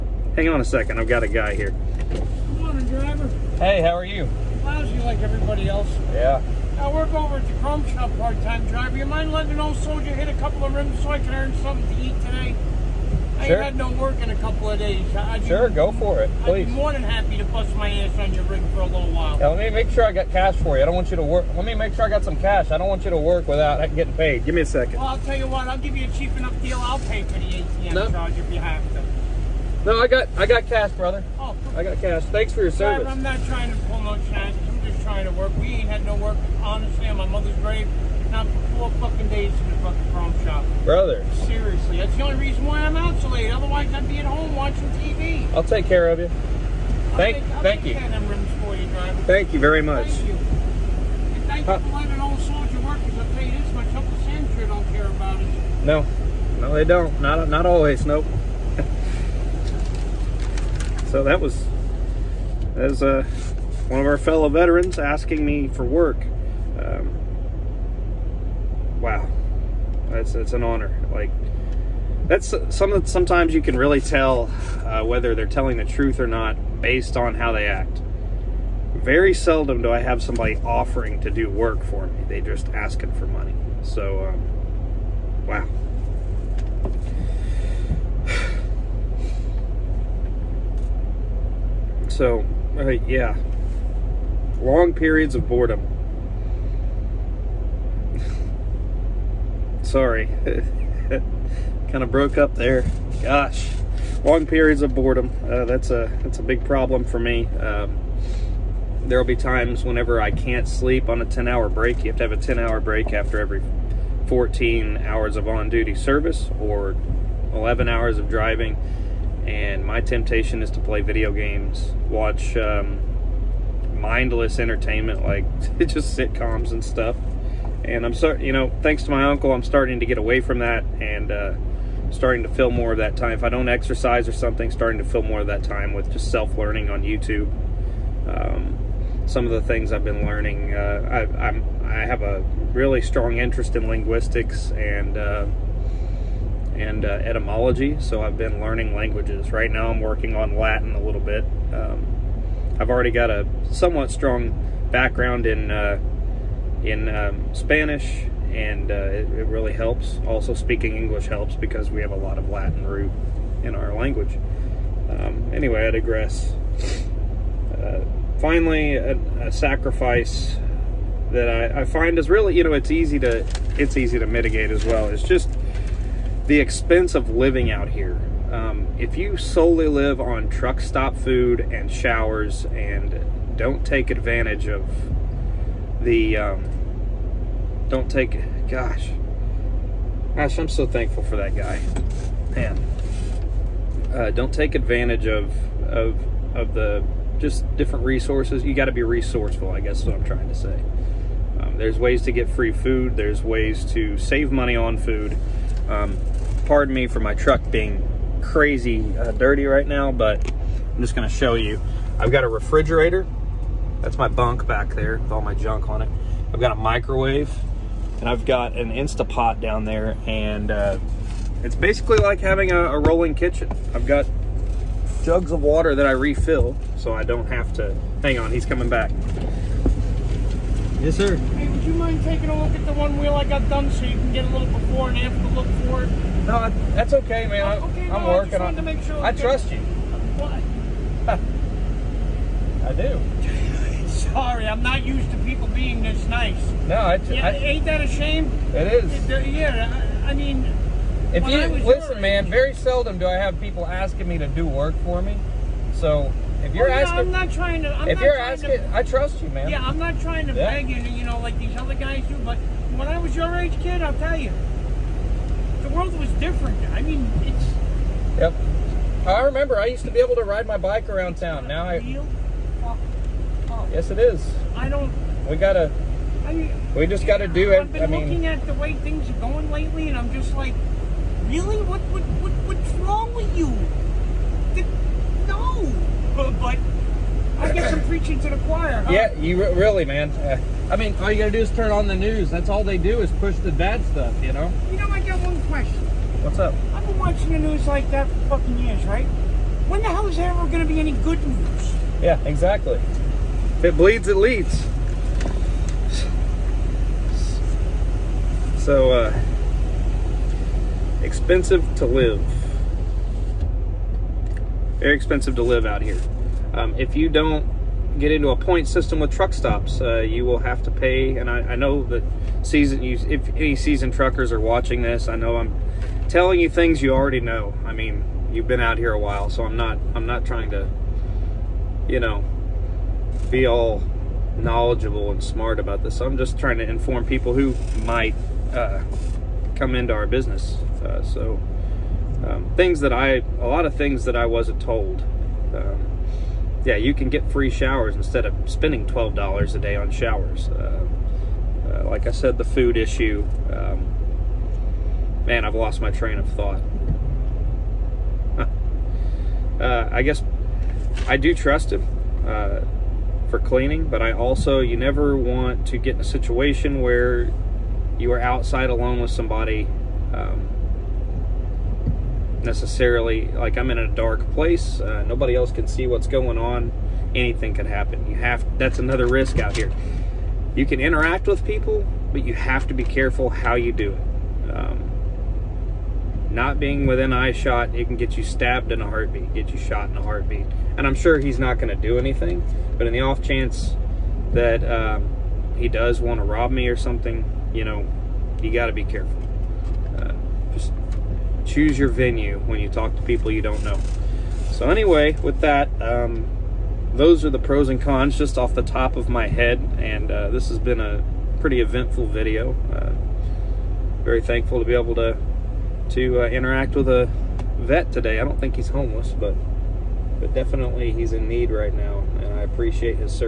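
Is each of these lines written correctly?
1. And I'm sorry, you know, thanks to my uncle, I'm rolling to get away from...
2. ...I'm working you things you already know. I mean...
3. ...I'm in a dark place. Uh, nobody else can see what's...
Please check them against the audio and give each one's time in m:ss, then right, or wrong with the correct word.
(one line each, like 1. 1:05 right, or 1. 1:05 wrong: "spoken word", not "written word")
1. 2:07 wrong: "starting", not "rolling"
2. 5:25 wrong: "telling", not "working"
3. 6:13 right.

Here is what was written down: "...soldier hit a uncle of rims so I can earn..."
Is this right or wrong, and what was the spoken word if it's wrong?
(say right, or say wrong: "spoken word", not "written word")
wrong: "couple", not "uncle".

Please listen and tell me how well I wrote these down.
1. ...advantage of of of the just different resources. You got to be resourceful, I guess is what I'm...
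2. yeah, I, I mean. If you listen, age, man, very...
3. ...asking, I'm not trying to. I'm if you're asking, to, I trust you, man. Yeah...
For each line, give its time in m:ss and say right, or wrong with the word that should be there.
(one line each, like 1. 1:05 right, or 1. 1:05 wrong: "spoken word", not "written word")
1. 3:14 right
2. 4:09 right
3. 4:16 right.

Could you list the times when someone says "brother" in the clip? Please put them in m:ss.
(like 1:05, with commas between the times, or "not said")
0:30, 0:40.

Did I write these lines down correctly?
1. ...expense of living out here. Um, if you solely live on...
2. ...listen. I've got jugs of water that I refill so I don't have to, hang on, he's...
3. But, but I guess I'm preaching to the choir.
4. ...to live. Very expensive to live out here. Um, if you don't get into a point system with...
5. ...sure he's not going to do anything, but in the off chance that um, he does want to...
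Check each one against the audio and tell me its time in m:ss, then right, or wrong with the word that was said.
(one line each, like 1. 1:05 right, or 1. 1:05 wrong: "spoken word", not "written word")
1. 2:56 right
2. 3:43 wrong: "kitchen", not "listen"
3. 4:46 right
4. 5:11 right
5. 6:31 right.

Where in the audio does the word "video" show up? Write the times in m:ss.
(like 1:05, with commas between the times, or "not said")
2:01, 6:52.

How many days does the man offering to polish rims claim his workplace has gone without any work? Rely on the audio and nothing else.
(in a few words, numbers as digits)
4.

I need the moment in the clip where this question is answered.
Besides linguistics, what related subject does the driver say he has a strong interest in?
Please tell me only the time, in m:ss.
2:27.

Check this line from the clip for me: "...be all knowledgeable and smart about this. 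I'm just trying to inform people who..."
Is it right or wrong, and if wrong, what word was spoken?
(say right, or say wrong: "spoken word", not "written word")
right.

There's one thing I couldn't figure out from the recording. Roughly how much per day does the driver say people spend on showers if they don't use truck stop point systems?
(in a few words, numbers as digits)
$12.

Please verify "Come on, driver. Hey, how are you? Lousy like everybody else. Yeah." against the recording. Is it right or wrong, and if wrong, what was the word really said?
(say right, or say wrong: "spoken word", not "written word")
right.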